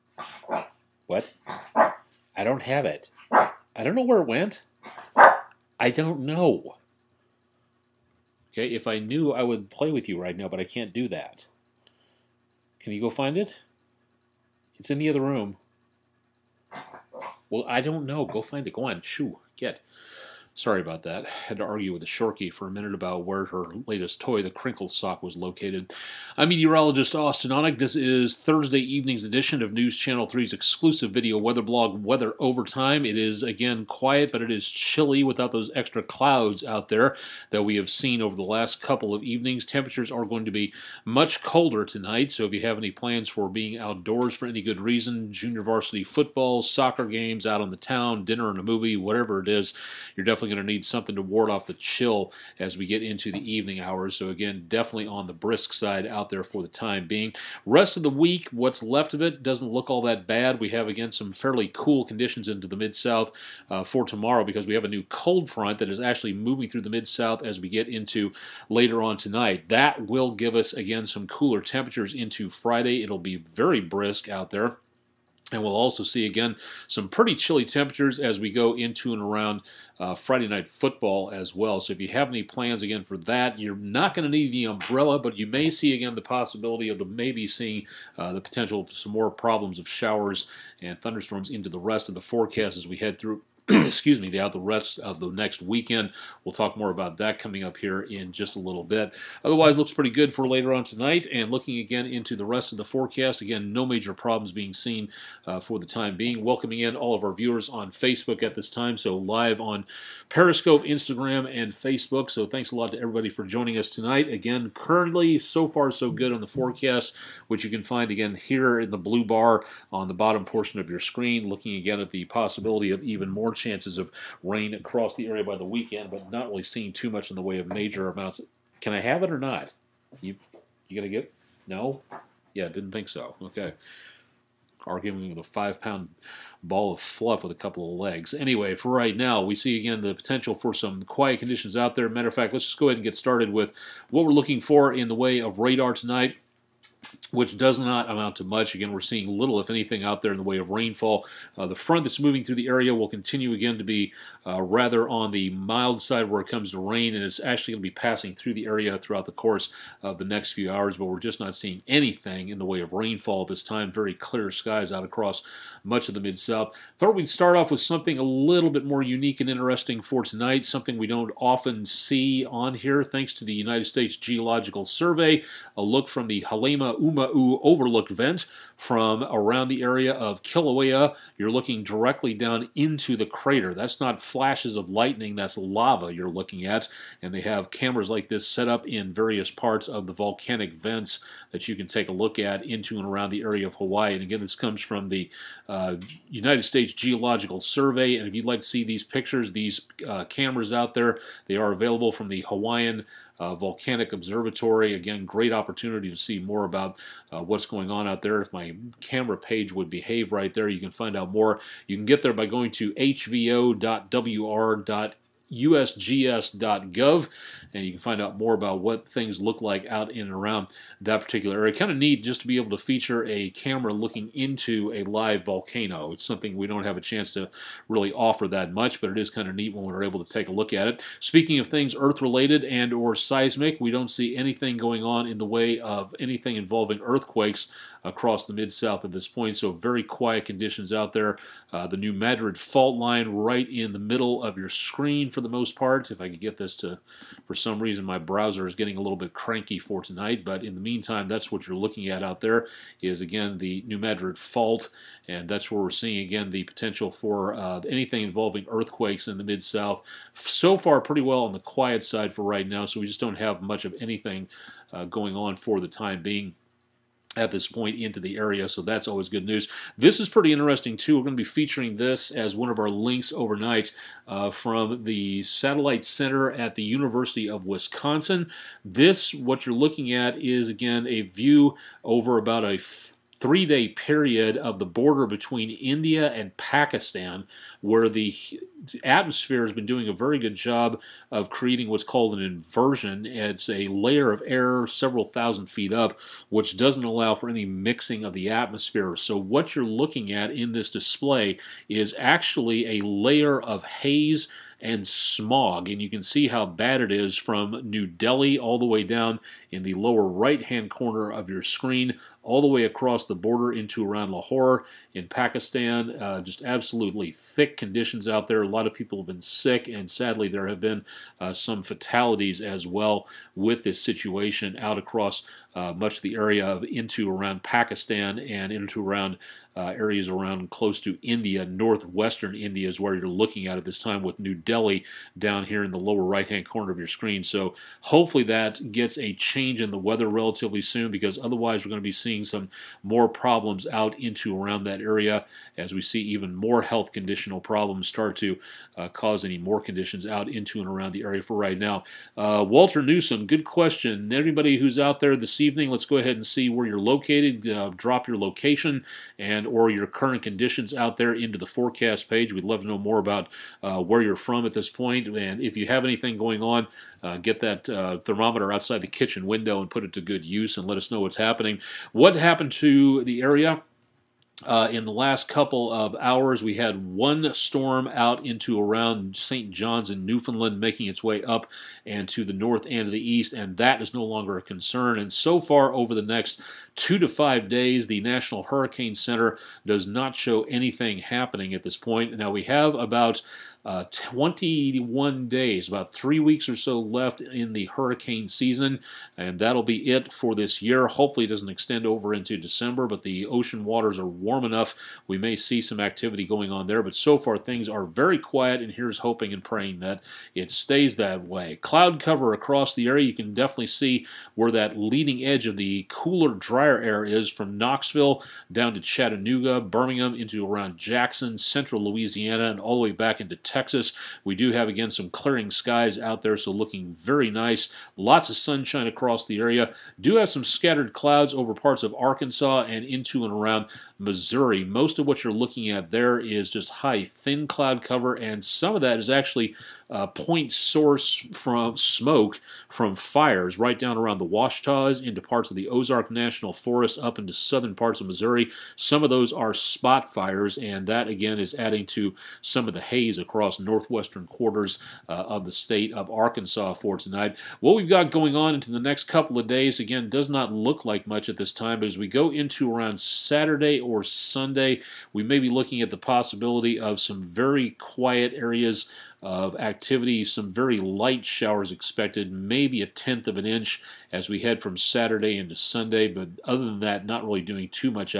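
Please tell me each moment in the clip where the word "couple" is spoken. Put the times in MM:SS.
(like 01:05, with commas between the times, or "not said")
00:38, 02:17, 06:15, 07:39.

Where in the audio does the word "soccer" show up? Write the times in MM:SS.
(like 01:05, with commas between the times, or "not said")
00:46.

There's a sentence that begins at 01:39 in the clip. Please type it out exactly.
Otherwise, looks pretty good for later on tonight.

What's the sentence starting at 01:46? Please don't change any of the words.
Welcoming in all of our viewers on Facebook at this time, so live on Periscope, Instagram, and Facebook.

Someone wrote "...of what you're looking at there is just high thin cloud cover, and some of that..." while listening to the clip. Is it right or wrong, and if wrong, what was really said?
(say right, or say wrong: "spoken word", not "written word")
right.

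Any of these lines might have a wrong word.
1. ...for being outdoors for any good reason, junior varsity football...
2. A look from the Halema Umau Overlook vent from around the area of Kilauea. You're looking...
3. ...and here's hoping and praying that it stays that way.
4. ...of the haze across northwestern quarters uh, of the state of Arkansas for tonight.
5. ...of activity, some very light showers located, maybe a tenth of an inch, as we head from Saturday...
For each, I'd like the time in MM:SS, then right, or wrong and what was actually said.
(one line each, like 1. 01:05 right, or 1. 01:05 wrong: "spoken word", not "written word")
1. 00:43 right
2. 02:55 right
3. 06:48 right
4. 07:32 right
5. 07:49 wrong: "expected", not "located".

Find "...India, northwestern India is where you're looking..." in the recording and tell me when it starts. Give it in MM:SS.
05:31.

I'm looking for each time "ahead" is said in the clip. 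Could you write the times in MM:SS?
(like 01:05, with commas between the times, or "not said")
02:22, 05:56.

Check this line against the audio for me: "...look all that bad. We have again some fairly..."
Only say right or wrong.
right.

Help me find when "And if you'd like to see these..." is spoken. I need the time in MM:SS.
03:18.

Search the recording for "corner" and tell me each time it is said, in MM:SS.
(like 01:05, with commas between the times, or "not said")
05:10, 05:36.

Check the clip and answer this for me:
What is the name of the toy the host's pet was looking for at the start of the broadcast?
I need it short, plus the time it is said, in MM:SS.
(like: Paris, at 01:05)
Crinkle Sock, at 00:24.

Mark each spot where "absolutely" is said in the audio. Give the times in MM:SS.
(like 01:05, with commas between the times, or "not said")
05:16.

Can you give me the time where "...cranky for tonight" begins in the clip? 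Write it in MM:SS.
04:09.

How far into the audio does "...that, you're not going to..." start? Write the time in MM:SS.
01:23.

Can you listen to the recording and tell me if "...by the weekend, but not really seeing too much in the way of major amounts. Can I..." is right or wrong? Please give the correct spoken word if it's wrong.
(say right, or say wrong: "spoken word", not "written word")
right.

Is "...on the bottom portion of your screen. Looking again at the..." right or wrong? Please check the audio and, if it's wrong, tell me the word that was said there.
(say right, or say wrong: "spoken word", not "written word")
right.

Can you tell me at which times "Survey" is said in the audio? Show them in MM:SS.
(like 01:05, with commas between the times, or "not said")
02:54, 03:17.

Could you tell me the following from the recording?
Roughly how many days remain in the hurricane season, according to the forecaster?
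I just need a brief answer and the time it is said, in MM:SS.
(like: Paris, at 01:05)
21, at 06:34.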